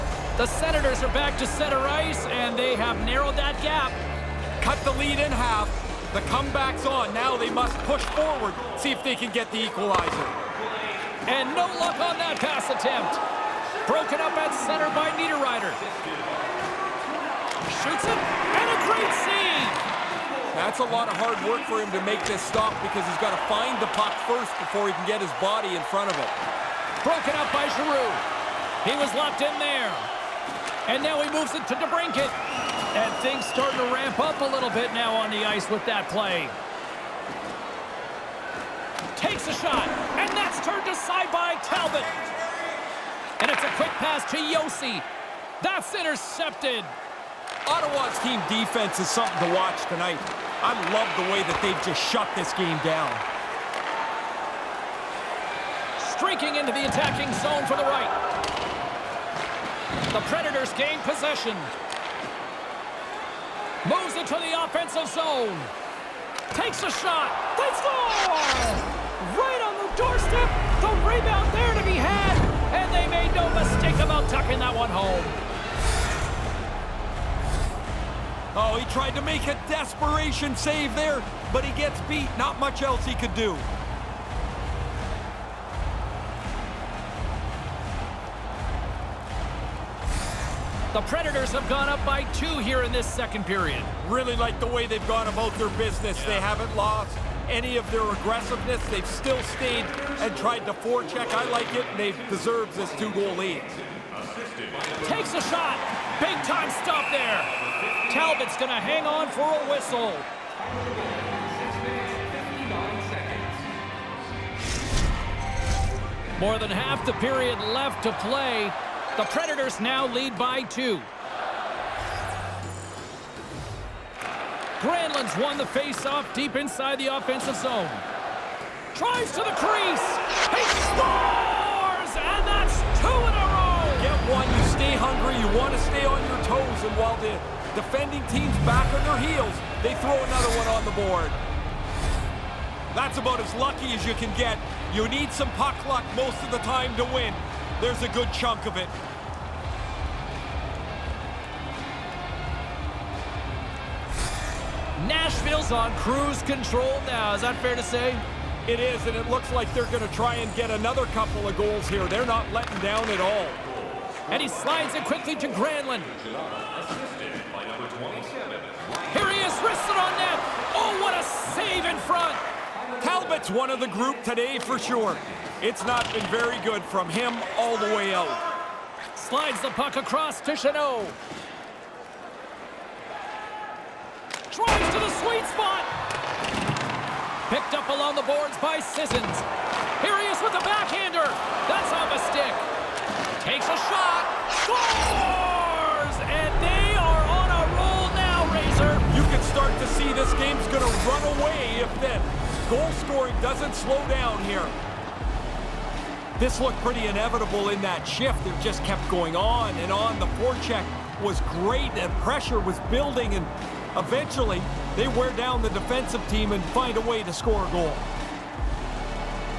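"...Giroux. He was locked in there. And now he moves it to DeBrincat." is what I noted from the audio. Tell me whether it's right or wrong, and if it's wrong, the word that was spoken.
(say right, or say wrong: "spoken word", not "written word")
right.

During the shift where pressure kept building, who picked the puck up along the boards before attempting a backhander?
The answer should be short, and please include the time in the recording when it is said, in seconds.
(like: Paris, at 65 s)
Sissons, at 188 s.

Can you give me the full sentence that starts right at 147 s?
There's a good chunk of it.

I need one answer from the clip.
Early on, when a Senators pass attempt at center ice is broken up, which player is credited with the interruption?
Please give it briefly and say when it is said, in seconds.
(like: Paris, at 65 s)
Niederreiter, at 15 s.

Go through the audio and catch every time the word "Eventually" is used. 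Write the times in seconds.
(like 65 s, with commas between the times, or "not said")
213 s.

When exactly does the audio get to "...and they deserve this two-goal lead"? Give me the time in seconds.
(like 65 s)
101 s.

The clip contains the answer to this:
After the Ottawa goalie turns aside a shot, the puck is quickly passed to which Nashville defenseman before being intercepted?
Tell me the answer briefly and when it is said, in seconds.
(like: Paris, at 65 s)
Josi, at 44 s.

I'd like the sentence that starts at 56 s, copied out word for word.
Streaking into the attacking zone for the right.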